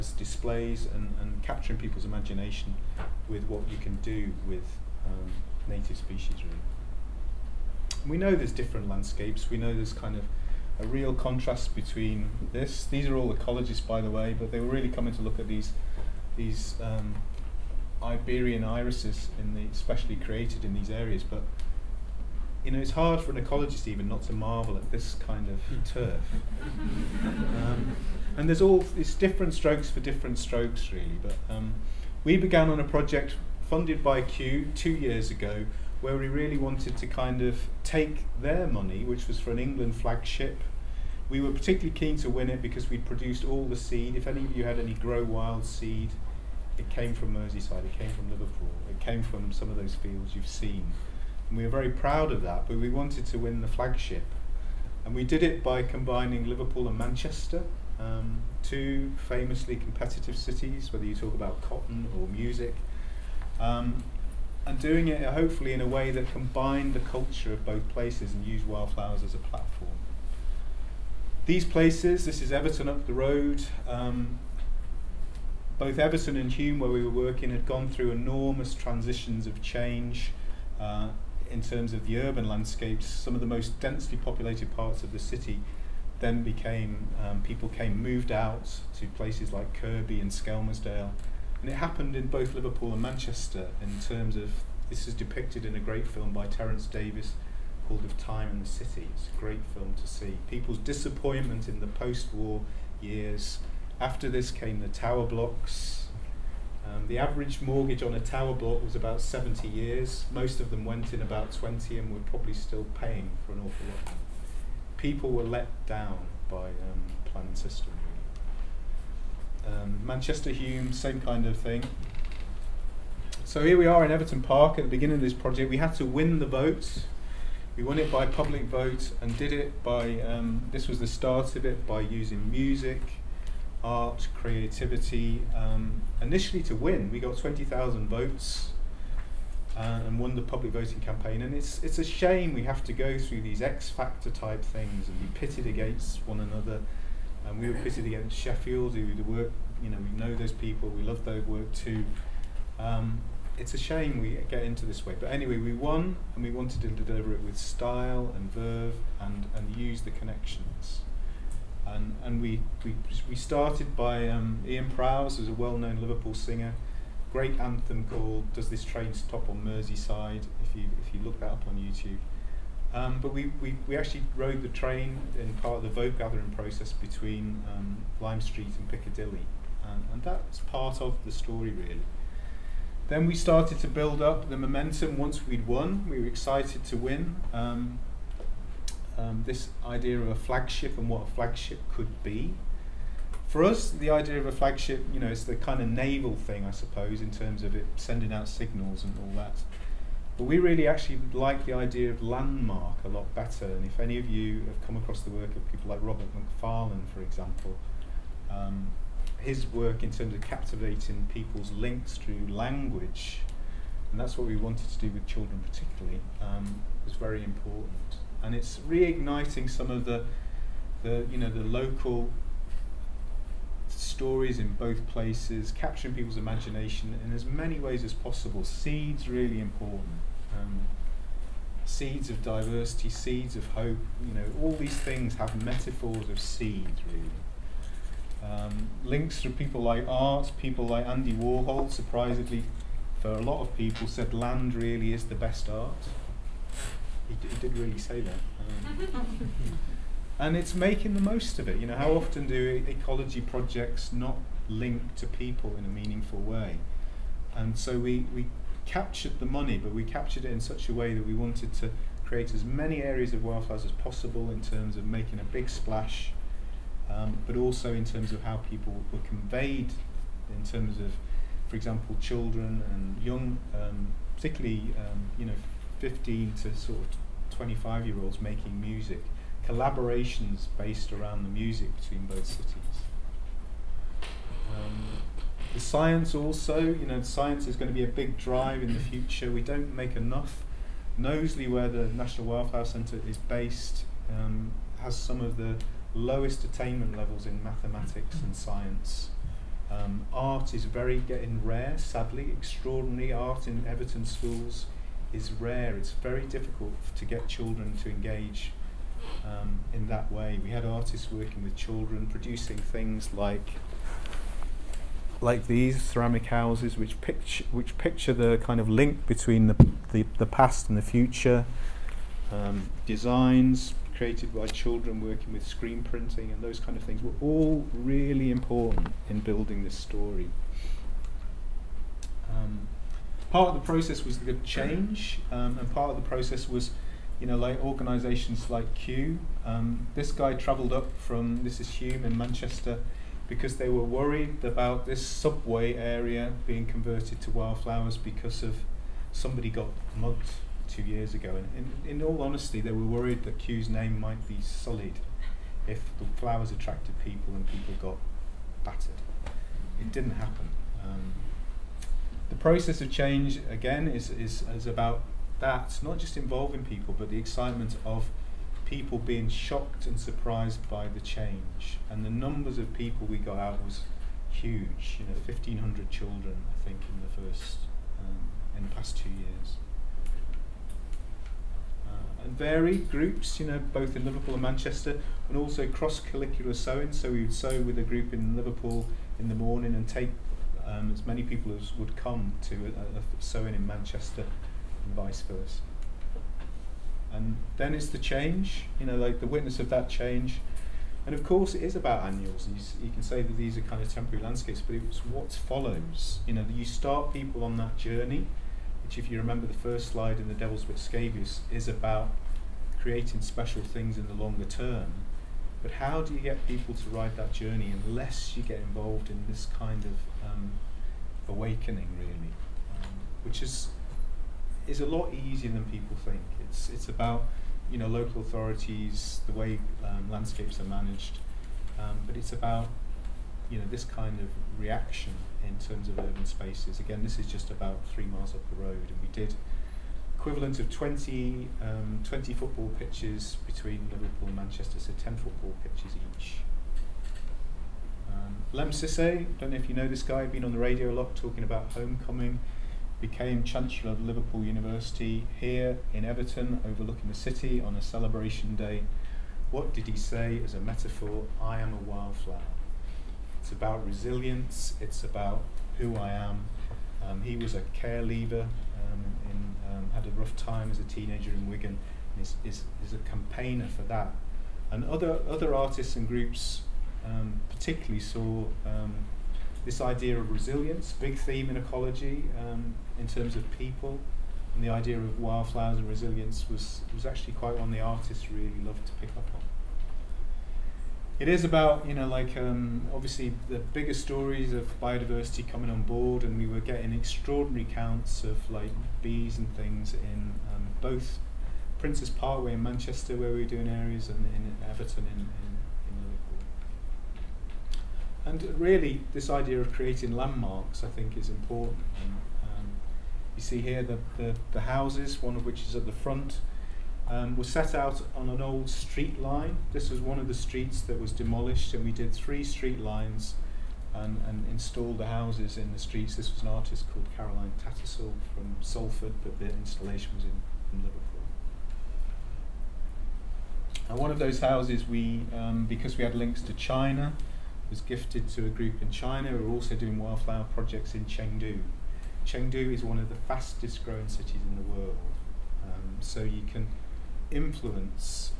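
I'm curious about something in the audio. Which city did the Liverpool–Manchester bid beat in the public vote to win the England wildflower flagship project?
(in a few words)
Sheffield.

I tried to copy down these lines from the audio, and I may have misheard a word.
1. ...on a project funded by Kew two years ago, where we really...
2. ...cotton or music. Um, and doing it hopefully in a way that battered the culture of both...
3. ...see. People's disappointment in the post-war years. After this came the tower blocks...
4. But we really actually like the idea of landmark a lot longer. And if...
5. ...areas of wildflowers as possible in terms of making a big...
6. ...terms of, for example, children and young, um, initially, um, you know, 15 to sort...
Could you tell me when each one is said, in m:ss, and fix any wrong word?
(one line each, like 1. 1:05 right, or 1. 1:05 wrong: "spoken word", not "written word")
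1. 0:32 right
2. 1:01 wrong: "combined", not "battered"
3. 1:40 right
4. 3:20 wrong: "better", not "longer"
5. 4:23 right
6. 4:30 wrong: "particularly", not "initially".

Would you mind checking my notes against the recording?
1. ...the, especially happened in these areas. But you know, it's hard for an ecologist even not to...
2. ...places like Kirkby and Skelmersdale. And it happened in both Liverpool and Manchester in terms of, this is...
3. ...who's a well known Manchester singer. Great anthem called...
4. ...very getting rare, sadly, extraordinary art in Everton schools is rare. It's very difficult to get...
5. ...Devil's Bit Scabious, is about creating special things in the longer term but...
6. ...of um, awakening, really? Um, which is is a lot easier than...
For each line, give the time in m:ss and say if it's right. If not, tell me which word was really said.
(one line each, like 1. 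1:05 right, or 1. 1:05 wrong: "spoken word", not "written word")
1. 0:19 wrong: "created", not "happened"
2. 1:29 right
3. 2:45 wrong: "Liverpool", not "Manchester"
4. 5:00 right
5. 6:50 right
6. 7:00 right.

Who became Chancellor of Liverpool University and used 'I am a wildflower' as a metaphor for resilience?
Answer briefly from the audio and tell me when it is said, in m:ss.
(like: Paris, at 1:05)
Lemn Sissay, at 7:28.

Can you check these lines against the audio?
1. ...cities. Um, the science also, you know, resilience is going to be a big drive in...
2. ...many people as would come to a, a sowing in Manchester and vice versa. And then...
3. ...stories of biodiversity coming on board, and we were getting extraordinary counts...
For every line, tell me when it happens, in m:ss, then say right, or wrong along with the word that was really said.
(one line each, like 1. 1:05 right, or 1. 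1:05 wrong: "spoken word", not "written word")
1. 4:42 wrong: "science", not "resilience"
2. 6:31 right
3. 8:14 right.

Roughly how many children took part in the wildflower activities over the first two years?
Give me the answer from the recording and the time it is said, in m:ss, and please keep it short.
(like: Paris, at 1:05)
1,500, at 6:15.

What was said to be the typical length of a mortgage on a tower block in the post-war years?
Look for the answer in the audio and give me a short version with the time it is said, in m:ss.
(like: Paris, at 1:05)
70 years, at 1:48.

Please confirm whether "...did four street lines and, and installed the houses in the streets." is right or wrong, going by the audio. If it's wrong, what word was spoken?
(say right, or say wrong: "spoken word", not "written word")
wrong: "three", not "four".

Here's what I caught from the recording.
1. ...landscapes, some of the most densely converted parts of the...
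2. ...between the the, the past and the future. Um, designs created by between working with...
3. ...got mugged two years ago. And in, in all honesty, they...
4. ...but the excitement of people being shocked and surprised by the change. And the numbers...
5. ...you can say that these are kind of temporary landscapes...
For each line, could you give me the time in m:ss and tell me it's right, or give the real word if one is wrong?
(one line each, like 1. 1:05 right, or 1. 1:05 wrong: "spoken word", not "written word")
1. 1:22 wrong: "populated", not "converted"
2. 5:19 wrong: "children", not "between"
3. 5:49 right
4. 6:07 right
5. 6:43 right.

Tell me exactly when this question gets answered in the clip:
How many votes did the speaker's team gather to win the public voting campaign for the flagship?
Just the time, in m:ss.
2:17.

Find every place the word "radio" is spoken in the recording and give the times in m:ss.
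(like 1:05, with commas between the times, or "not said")
7:30.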